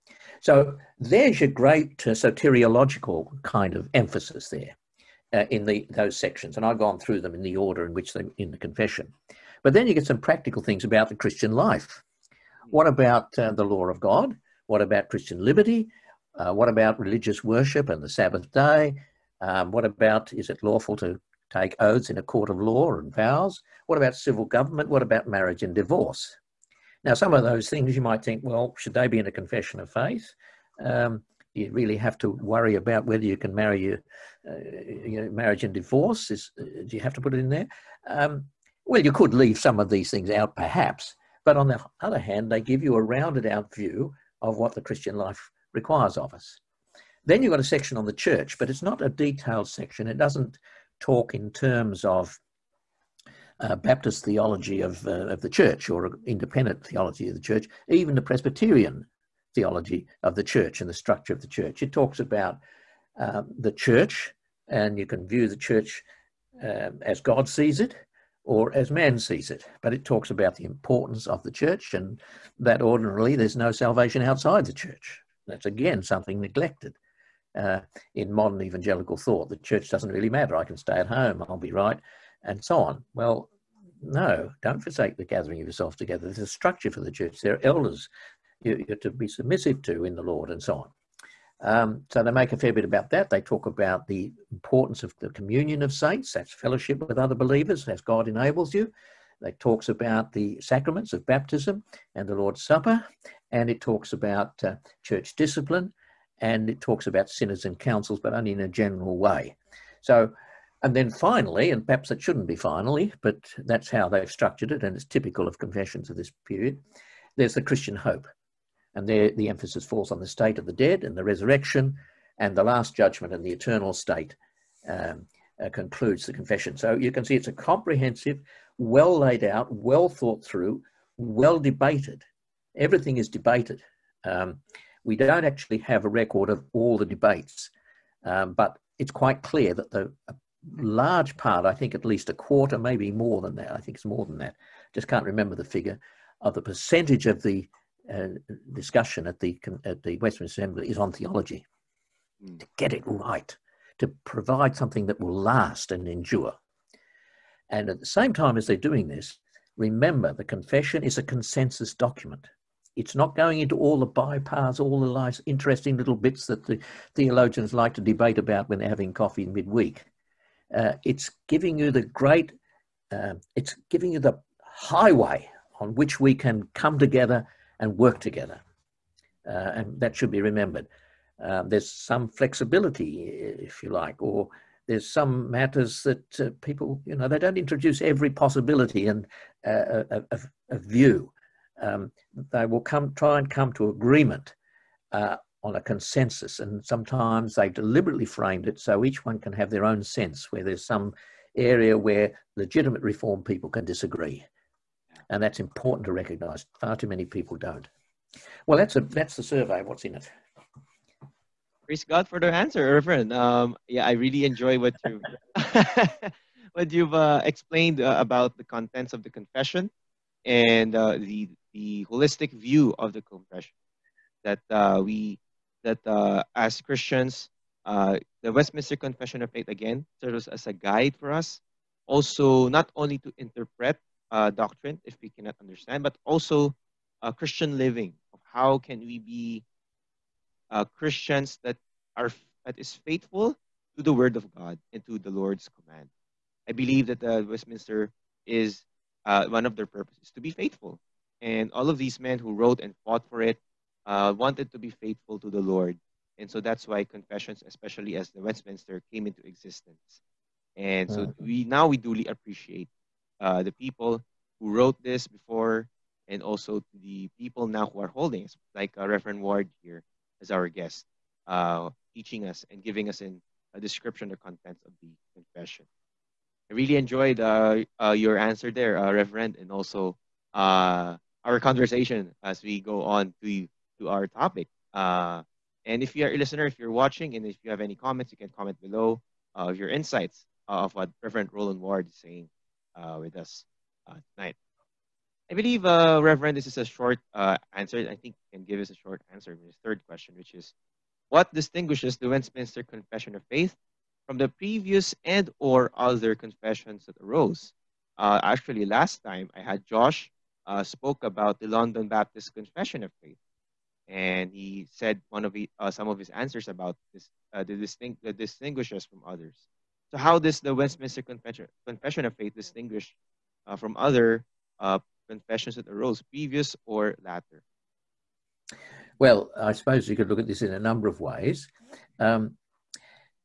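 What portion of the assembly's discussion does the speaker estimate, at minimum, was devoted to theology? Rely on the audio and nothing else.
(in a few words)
a quarter.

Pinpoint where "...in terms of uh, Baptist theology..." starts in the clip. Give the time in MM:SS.
00:51.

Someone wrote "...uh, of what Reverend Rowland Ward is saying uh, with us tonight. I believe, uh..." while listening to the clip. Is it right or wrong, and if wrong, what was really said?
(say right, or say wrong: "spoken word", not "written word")
right.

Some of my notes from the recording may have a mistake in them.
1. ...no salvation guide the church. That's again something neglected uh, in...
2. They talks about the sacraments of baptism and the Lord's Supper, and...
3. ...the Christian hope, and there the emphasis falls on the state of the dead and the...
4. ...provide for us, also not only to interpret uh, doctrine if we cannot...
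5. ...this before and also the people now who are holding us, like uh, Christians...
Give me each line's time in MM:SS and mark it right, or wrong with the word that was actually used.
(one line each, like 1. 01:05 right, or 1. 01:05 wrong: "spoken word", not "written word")
1. 01:13 wrong: "outside", not "guide"
2. 01:39 right
3. 01:57 right
4. 03:50 wrong: "guide", not "provide"
5. 04:25 wrong: "Reverend", not "Christians".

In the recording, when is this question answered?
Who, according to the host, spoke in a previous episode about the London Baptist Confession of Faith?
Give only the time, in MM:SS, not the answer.
05:09.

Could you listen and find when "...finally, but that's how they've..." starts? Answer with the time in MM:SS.
01:52.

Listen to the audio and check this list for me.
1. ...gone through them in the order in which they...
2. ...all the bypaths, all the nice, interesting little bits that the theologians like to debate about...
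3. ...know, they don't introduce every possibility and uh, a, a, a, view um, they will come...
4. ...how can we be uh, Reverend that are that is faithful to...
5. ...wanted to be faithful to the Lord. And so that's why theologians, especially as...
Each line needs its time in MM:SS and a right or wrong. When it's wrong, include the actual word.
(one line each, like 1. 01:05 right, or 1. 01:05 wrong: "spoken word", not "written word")
1. 00:06 right
2. 02:43 right
3. 03:07 right
4. 03:58 wrong: "Christians", not "Reverend"
5. 04:14 wrong: "confessions", not "theologians".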